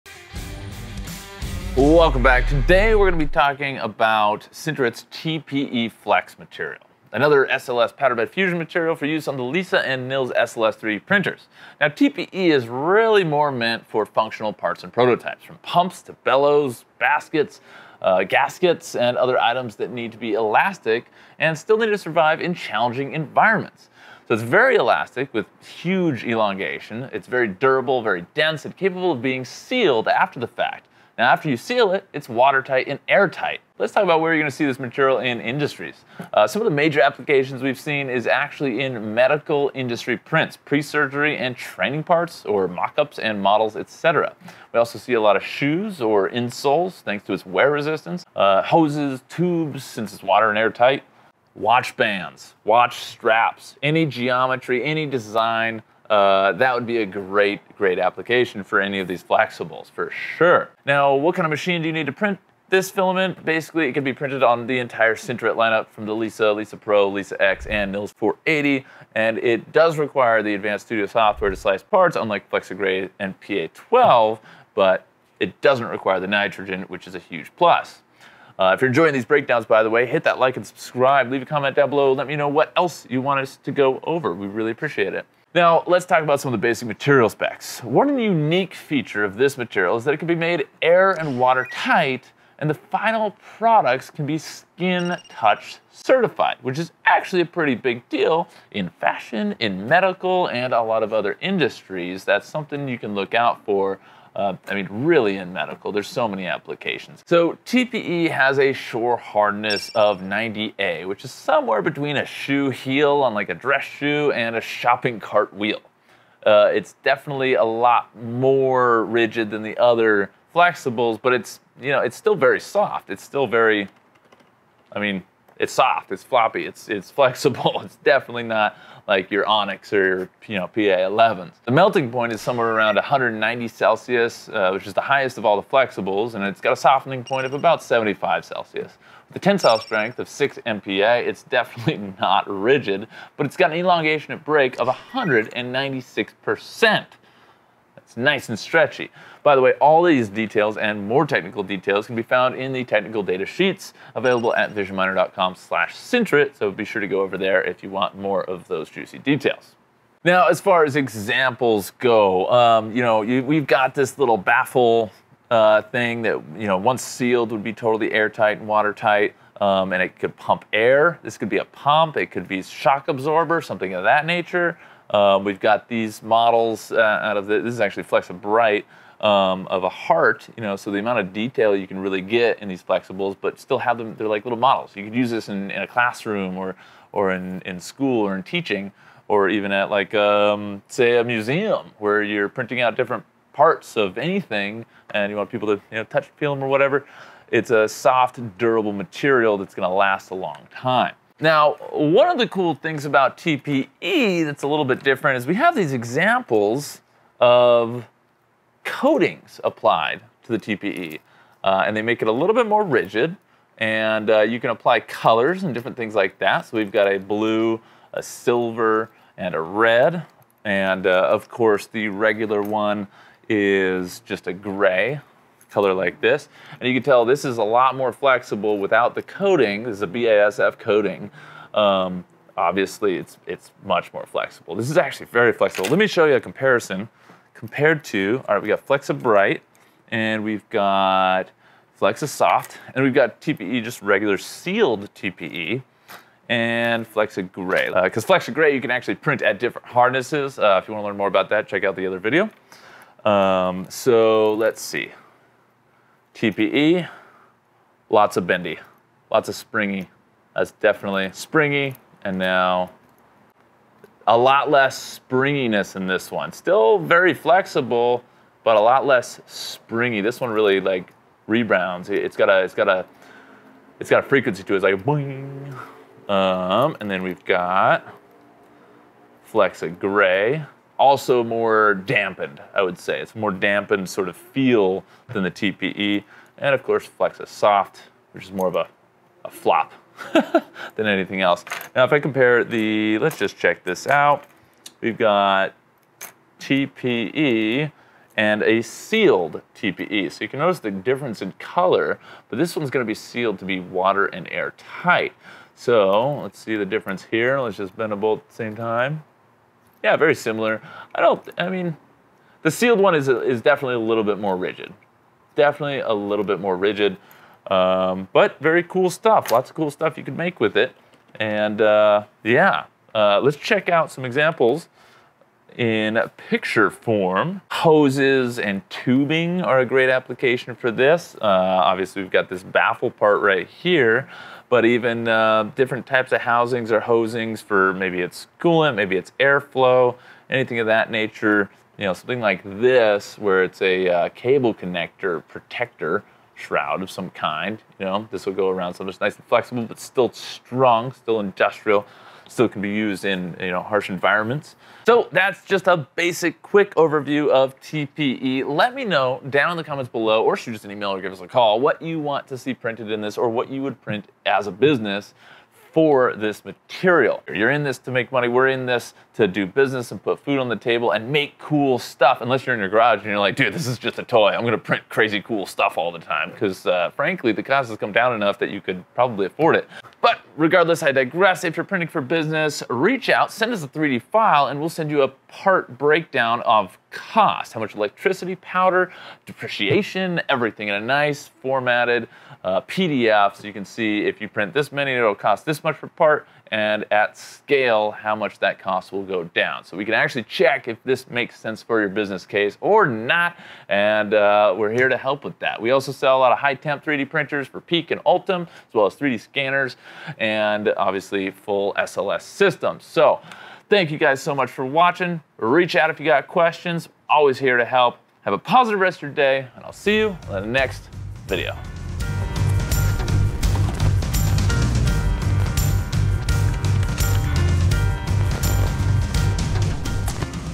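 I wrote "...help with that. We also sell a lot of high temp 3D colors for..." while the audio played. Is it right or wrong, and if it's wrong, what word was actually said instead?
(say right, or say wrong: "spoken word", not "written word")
wrong: "printers", not "colors".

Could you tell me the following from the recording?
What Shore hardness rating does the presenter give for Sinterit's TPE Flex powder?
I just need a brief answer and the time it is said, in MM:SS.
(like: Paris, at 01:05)
90A, at 01:50.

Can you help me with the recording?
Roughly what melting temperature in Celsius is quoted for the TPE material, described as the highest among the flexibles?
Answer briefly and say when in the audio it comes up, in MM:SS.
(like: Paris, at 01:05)
190 Celsius, at 02:12.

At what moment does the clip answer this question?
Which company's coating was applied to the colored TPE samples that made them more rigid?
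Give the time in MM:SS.
03:50.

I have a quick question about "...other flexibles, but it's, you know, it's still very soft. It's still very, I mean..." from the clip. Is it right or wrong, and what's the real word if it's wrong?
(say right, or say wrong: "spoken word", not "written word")
right.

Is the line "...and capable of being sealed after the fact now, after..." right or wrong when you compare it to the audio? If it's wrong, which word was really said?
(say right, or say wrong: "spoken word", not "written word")
right.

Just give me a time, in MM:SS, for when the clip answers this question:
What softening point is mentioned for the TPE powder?
02:17.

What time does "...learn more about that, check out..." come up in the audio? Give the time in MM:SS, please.
04:11.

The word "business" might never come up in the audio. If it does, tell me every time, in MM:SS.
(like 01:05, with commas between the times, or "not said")
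06:04, 06:09, 06:22, 06:42.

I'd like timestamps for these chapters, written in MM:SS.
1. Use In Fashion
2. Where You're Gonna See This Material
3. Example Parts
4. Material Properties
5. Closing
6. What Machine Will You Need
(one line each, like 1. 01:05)
1. 03:40
2. 00:25
3. 02:46
4. 01:21
5. 05:14
6. 00:38.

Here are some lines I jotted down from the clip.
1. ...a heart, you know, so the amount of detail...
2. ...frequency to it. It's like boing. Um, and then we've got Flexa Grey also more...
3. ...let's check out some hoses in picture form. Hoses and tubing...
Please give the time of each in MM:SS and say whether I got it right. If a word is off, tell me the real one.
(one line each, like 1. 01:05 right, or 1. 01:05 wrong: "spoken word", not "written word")
1. 02:59 right
2. 04:34 right
3. 05:23 wrong: "examples", not "hoses".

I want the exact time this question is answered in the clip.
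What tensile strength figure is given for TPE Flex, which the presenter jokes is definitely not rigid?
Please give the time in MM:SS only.
02:20.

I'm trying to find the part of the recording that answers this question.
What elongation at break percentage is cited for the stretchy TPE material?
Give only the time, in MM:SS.
02:24.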